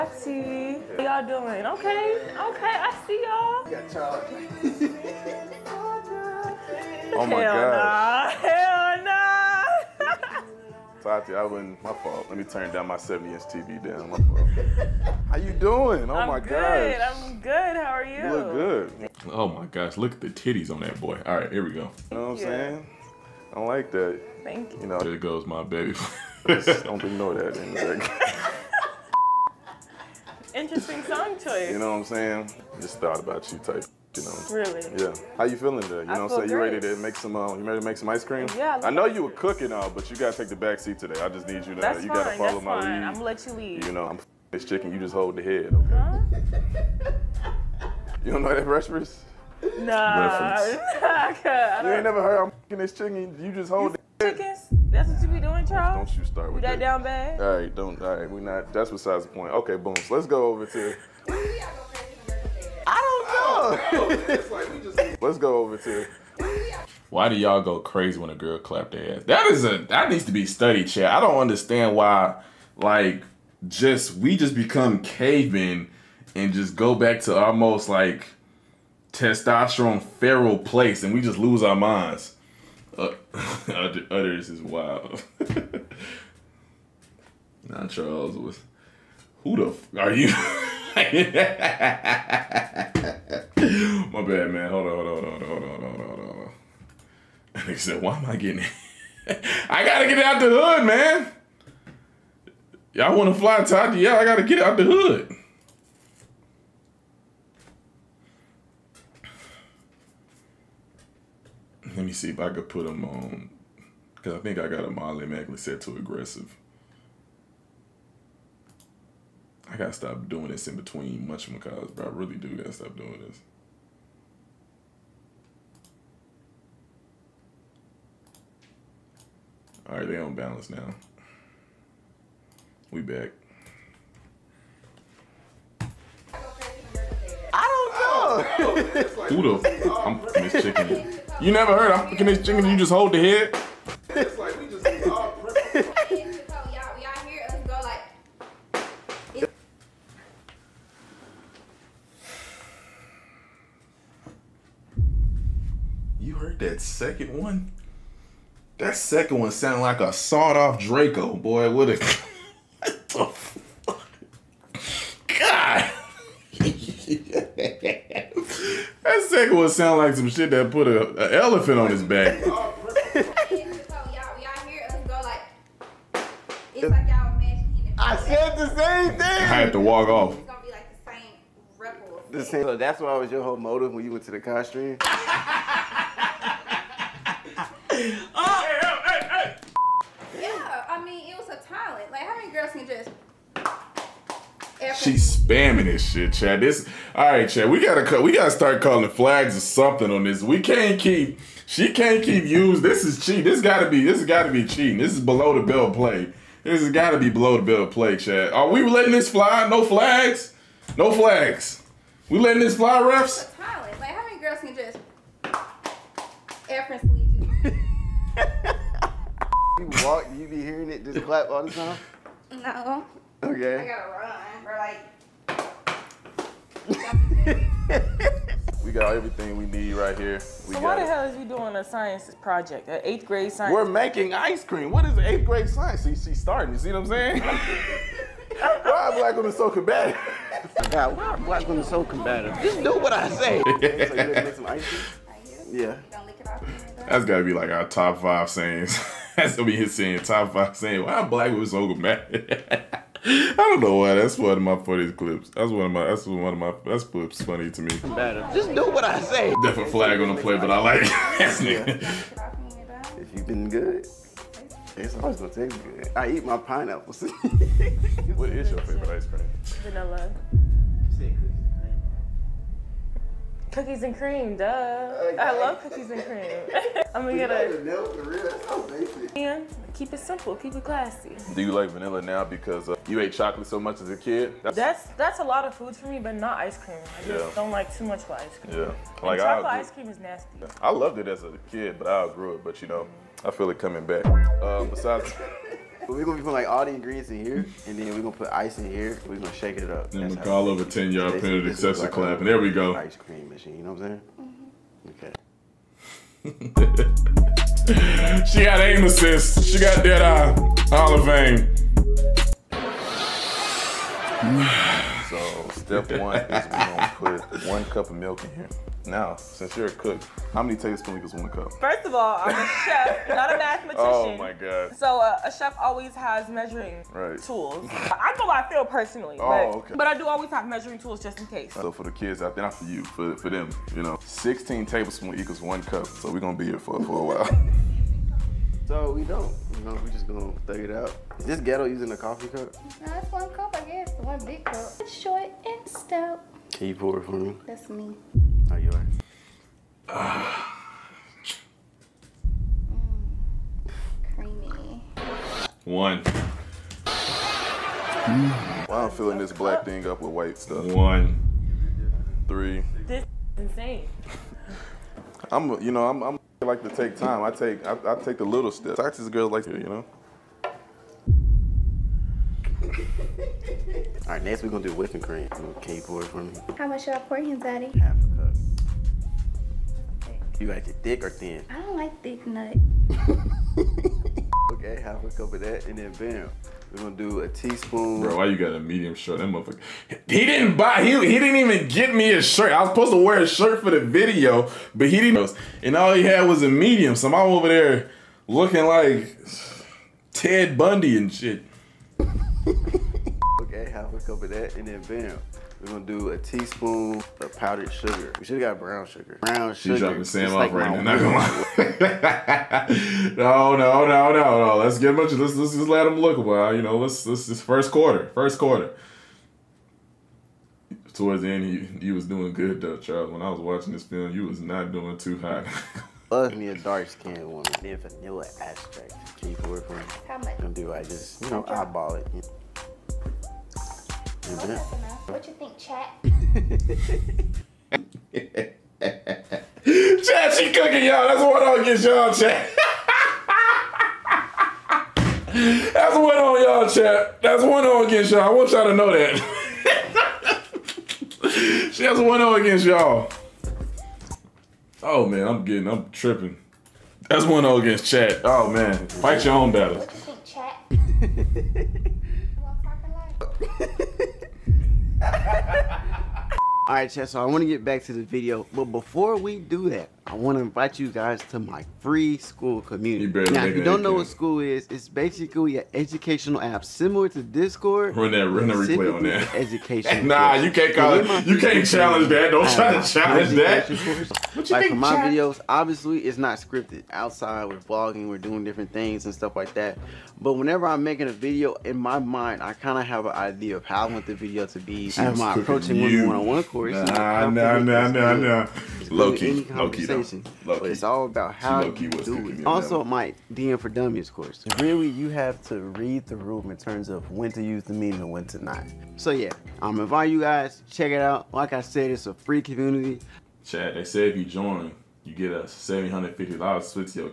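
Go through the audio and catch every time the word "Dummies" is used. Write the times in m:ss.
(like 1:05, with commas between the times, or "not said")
8:23.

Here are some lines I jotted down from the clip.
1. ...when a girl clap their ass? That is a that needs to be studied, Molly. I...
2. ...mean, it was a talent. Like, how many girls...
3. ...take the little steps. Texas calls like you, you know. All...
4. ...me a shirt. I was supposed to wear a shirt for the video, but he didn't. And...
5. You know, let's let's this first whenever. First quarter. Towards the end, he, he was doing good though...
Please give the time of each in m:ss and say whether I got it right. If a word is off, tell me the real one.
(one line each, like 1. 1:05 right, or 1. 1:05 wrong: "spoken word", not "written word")
1. 1:08 wrong: "Chad", not "Molly"
2. 3:11 right
3. 6:08 wrong: "girls", not "calls"
4. 6:32 right
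5. 6:56 wrong: "quarter", not "whenever".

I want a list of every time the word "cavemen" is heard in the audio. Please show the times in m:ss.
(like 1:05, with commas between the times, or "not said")
1:15.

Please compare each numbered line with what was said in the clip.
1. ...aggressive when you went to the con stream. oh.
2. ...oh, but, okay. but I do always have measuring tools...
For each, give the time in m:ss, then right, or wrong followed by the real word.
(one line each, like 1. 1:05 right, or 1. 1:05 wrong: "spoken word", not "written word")
1. 3:03 wrong: "motive", not "aggressive"
2. 5:29 right.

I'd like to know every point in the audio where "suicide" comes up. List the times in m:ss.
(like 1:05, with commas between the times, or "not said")
not said.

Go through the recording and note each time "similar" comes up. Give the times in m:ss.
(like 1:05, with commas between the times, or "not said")
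7:56.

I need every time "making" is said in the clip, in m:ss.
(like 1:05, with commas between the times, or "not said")
3:53, 8:11.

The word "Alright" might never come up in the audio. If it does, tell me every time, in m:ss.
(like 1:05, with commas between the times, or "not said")
7:46.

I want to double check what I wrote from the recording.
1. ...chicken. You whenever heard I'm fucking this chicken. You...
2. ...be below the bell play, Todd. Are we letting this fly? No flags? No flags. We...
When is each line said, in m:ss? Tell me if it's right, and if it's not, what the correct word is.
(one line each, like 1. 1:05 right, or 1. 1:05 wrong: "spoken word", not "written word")
1. 2:20 wrong: "never", not "whenever"
2. 3:27 wrong: "Chad", not "Todd".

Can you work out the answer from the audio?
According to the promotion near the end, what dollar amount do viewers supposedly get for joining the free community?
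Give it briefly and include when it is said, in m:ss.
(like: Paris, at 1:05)
$750, at 8:35.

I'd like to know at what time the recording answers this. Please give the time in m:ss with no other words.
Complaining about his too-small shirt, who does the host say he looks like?
6:40.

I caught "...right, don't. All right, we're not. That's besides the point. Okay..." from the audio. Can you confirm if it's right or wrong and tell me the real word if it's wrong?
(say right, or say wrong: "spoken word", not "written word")
right.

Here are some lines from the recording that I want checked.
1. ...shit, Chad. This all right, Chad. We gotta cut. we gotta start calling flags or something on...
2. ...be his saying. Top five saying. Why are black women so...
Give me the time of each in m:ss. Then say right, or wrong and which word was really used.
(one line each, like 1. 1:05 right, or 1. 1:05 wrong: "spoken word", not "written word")
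1. 3:16 right
2. 4:09 right.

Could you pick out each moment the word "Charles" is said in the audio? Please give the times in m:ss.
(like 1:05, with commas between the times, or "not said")
1:27, 7:02.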